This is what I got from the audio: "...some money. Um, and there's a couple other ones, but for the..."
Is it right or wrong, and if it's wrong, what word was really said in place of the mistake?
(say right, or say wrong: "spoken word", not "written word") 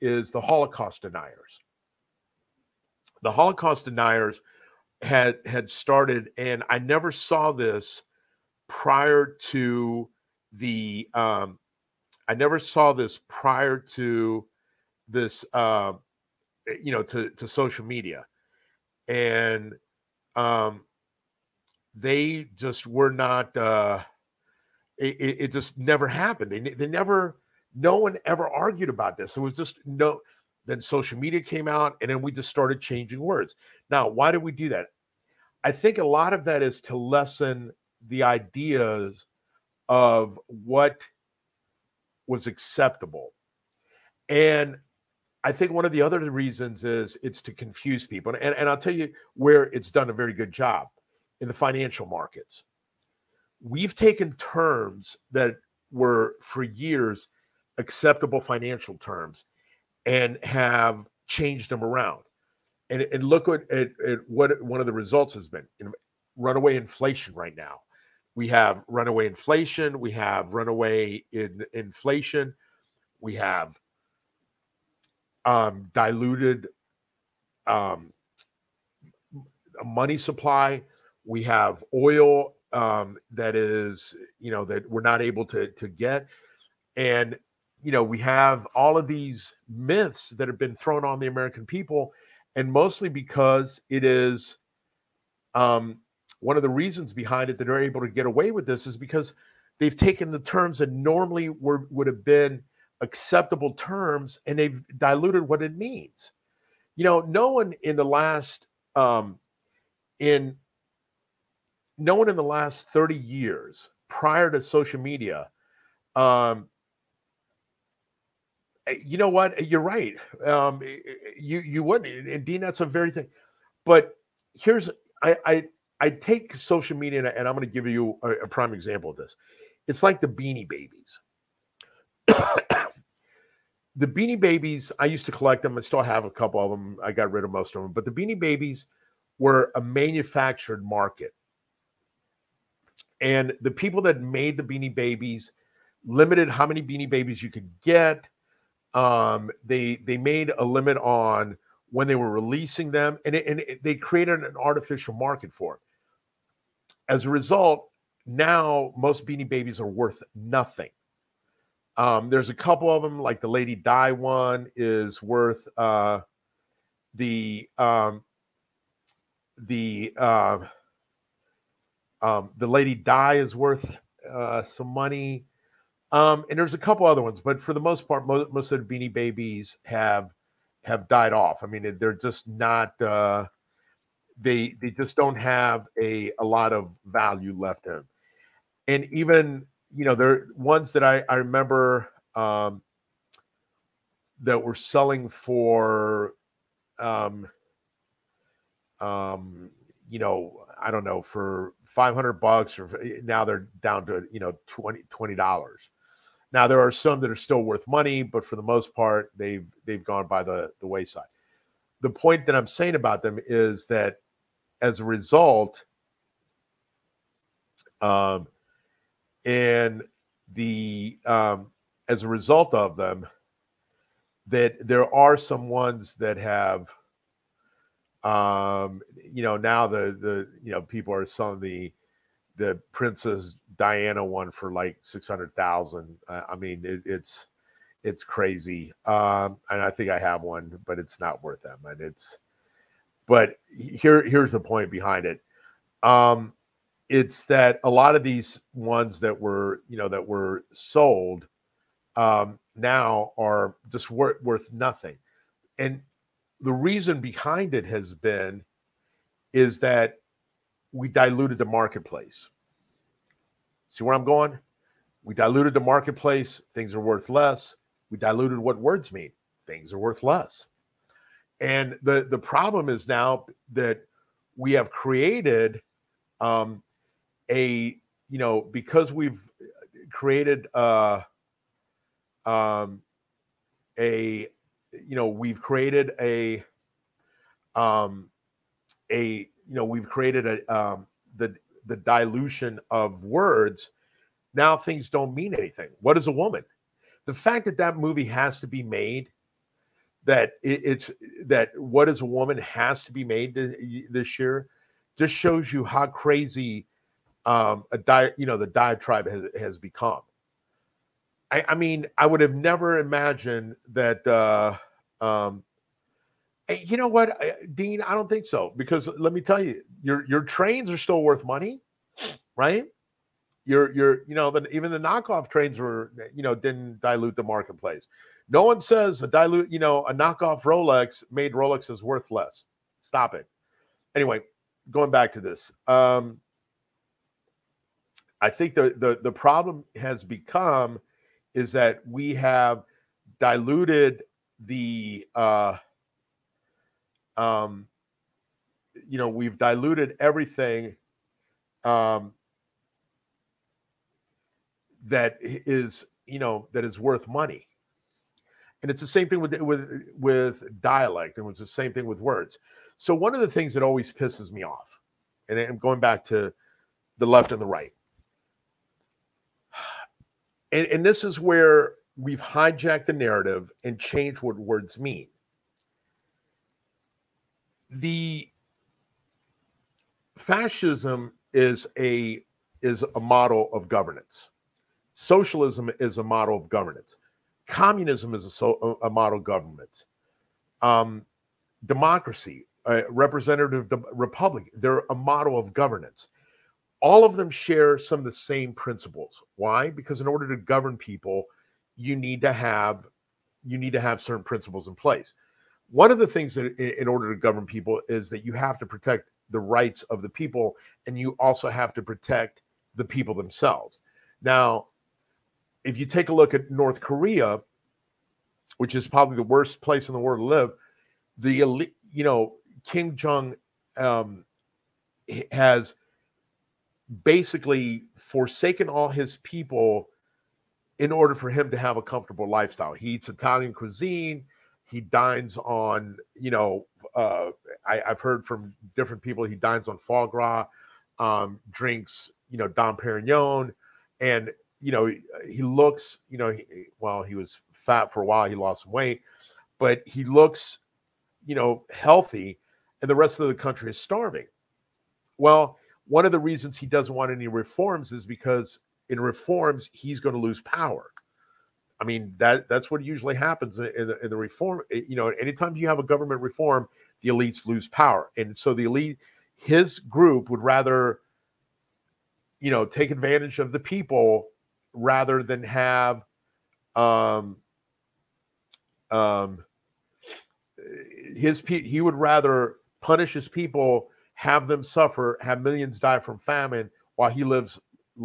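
right.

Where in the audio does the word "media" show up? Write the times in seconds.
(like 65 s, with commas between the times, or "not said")
17 s, 31 s, 115 s, 126 s.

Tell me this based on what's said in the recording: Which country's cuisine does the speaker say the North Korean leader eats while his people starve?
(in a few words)
Italian.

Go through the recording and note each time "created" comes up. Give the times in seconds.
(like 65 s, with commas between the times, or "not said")
153 s, 274 s, 280 s, 285 s, 290 s.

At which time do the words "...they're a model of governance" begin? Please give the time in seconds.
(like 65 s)
394 s.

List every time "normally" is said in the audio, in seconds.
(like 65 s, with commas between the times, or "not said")
100 s.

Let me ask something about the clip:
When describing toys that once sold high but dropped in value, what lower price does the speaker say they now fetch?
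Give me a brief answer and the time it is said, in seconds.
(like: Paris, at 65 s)
$20, at 204 s.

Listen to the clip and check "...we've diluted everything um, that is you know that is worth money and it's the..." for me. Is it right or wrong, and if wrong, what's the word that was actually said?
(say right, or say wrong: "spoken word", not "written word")
right.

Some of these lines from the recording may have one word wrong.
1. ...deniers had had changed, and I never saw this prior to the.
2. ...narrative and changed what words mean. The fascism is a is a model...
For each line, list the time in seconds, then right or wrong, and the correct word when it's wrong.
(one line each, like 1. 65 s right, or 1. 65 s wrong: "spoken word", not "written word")
1. 3 s wrong: "started", not "changed"
2. 373 s right.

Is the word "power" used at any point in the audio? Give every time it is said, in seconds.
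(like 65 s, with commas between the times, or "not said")
460 s, 467 s.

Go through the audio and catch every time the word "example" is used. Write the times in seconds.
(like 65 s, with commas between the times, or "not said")
128 s.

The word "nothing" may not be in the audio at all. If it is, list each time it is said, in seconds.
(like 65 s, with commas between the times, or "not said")
160 s, 254 s.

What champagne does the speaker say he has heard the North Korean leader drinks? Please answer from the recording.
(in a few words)
Dom Perignon.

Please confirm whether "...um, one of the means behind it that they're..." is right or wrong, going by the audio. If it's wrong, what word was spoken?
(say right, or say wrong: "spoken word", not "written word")
wrong: "reasons", not "means".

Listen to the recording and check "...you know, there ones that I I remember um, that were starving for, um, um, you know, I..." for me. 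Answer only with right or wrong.
wrong.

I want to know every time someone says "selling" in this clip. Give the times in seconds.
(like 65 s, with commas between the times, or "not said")
194 s, 231 s.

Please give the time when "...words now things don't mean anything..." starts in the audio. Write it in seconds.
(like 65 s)
293 s.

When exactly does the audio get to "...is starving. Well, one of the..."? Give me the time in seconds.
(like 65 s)
453 s.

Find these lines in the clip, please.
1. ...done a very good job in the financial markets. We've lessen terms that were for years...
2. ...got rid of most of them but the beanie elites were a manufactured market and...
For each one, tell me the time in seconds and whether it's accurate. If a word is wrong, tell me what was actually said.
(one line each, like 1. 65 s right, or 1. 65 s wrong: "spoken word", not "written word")
1. 49 s wrong: "taken", not "lessen"
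2. 137 s wrong: "babies", not "elites".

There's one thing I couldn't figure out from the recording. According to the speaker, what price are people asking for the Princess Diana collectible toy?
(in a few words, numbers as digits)
600,000.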